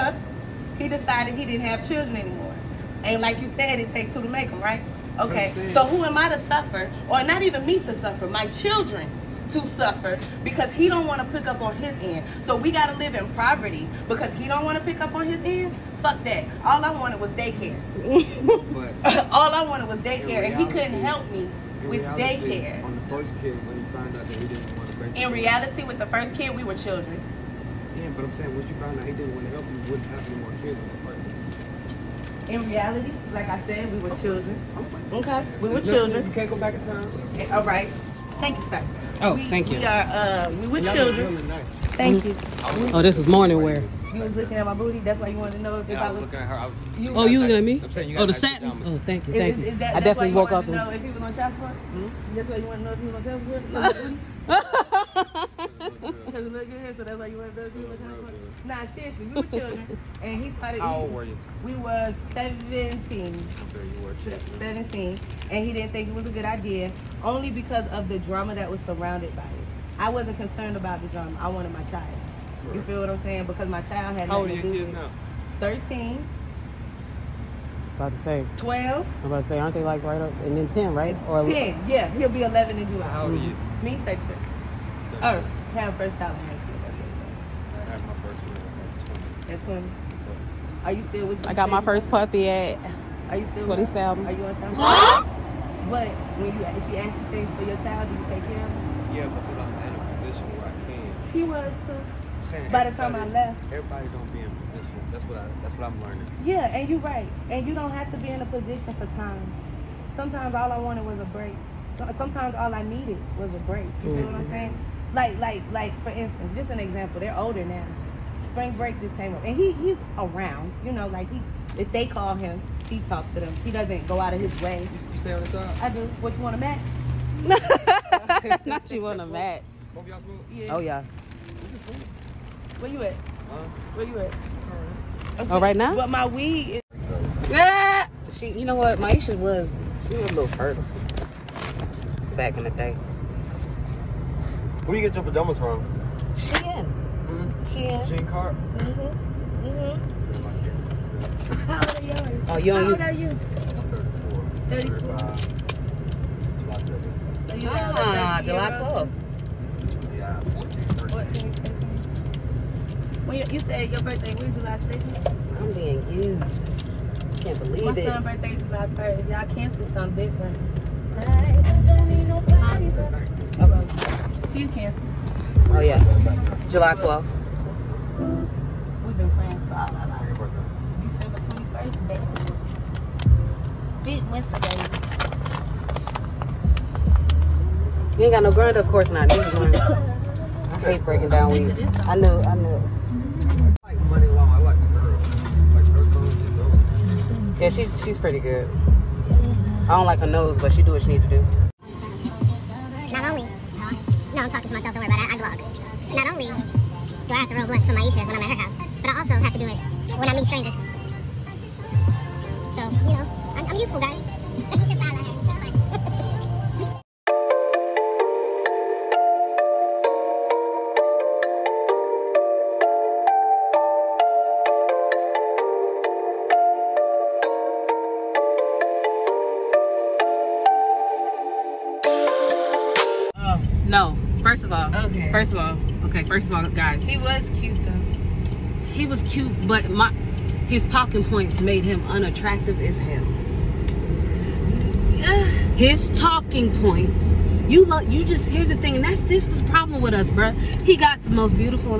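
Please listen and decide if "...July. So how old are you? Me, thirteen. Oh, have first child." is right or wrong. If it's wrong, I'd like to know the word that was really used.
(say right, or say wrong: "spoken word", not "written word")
right.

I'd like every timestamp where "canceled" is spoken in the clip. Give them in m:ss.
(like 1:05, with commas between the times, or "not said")
2:49, 2:54.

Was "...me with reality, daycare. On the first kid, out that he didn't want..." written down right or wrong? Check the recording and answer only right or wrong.
right.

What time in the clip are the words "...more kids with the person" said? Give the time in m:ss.
0:30.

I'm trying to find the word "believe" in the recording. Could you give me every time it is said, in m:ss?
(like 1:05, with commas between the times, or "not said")
2:47.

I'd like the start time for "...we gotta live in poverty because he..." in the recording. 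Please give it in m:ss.
0:12.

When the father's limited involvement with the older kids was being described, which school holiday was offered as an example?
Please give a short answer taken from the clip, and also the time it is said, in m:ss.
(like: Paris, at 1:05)
spring break, at 1:58.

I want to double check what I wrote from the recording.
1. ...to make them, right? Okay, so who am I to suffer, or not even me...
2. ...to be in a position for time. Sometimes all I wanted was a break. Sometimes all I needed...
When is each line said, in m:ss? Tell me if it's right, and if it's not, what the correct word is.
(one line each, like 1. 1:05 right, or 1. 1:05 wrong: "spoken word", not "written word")
1. 0:04 right
2. 1:48 right.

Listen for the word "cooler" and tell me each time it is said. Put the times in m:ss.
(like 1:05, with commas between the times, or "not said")
not said.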